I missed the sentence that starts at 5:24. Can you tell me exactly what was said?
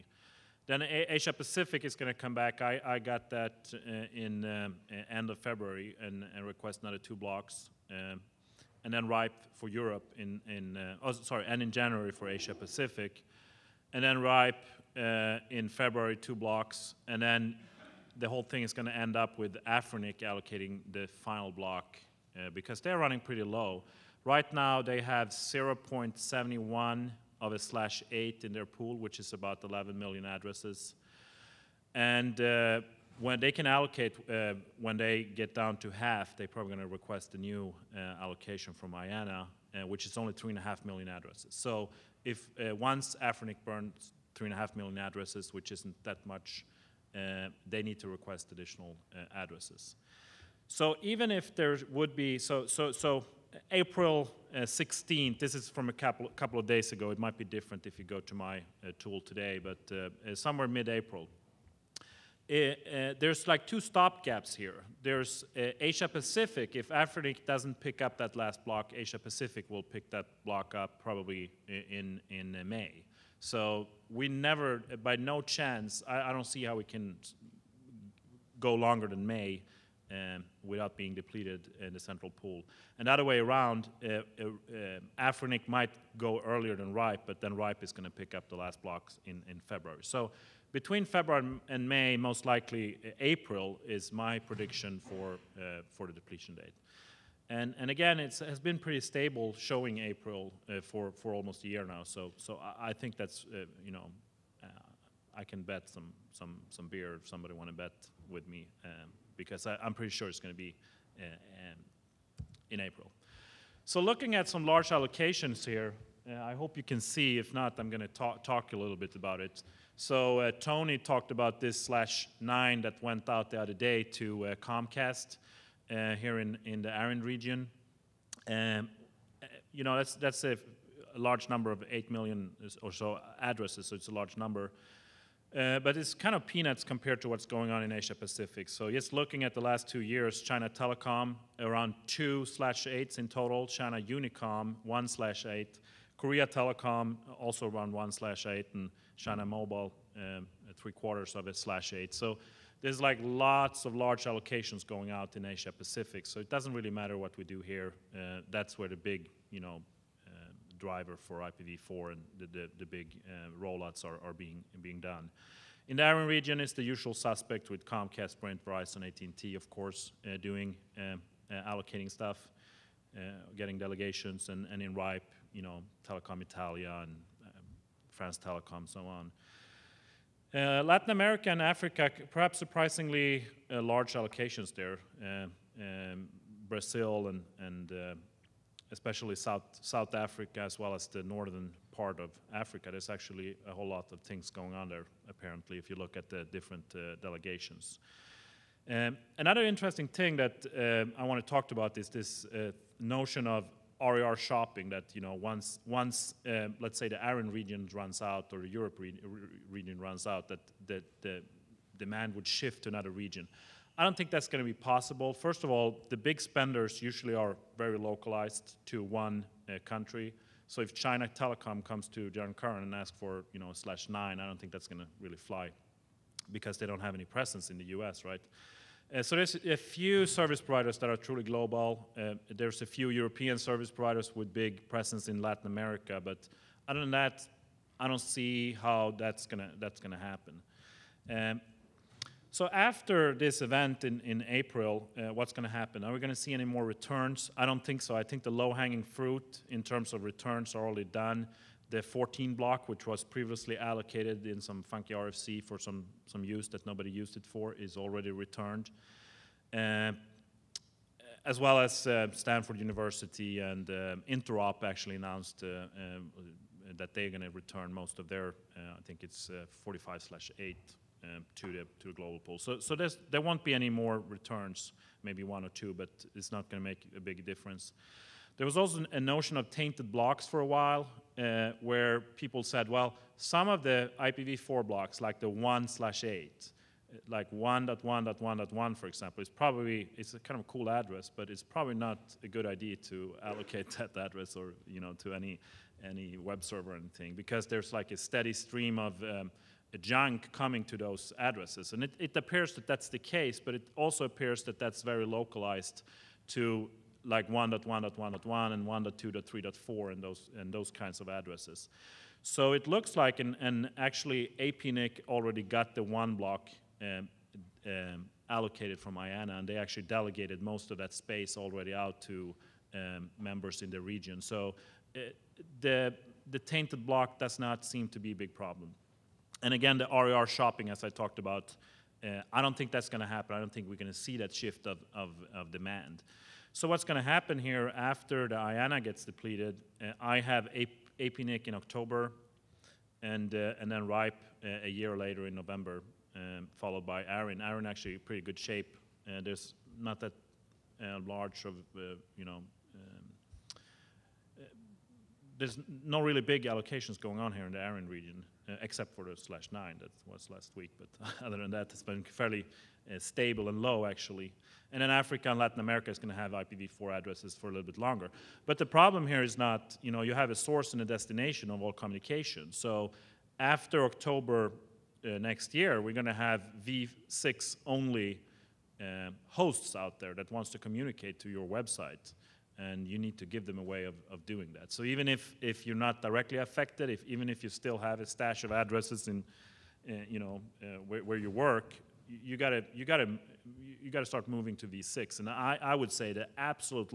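So uh, the, the tainted block does not seem to be a big problem.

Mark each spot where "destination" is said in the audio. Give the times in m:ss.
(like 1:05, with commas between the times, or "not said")
6:11.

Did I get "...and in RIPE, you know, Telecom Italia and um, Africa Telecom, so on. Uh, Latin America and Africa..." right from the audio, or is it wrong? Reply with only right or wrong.
wrong.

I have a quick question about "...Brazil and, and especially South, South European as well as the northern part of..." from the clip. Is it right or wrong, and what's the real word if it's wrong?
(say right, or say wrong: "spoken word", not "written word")
wrong: "Africa", not "European".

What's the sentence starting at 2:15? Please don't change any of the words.
Uh, but it's kind of peanuts compared to what's going on in Asia Pacific.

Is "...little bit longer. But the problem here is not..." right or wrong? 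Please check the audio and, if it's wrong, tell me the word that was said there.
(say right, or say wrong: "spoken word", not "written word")
right.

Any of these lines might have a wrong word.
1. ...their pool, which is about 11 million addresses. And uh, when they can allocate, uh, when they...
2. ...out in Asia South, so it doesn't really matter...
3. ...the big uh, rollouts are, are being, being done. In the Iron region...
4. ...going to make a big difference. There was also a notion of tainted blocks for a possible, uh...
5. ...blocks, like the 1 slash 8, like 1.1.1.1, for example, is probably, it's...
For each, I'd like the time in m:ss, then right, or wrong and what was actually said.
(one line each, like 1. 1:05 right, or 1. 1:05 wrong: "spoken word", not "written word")
1. 0:28 right
2. 2:35 wrong: "Pacific", not "South"
3. 2:42 right
4. 4:36 wrong: "while", not "possible"
5. 4:44 right.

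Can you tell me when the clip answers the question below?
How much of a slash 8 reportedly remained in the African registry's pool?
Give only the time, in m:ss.
0:25.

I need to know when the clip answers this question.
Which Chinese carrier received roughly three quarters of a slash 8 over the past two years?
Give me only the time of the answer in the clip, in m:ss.
2:29.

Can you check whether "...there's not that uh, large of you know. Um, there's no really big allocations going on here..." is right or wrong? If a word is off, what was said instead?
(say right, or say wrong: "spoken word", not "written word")
right.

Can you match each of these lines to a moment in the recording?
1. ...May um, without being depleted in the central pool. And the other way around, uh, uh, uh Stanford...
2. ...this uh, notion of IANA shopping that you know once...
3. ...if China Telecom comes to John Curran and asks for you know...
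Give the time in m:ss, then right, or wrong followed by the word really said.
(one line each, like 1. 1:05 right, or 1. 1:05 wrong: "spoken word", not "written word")
1. 1:19 wrong: "Afrinic", not "Stanford"
2. 3:22 wrong: "RIR", not "IANA"
3. 3:40 right.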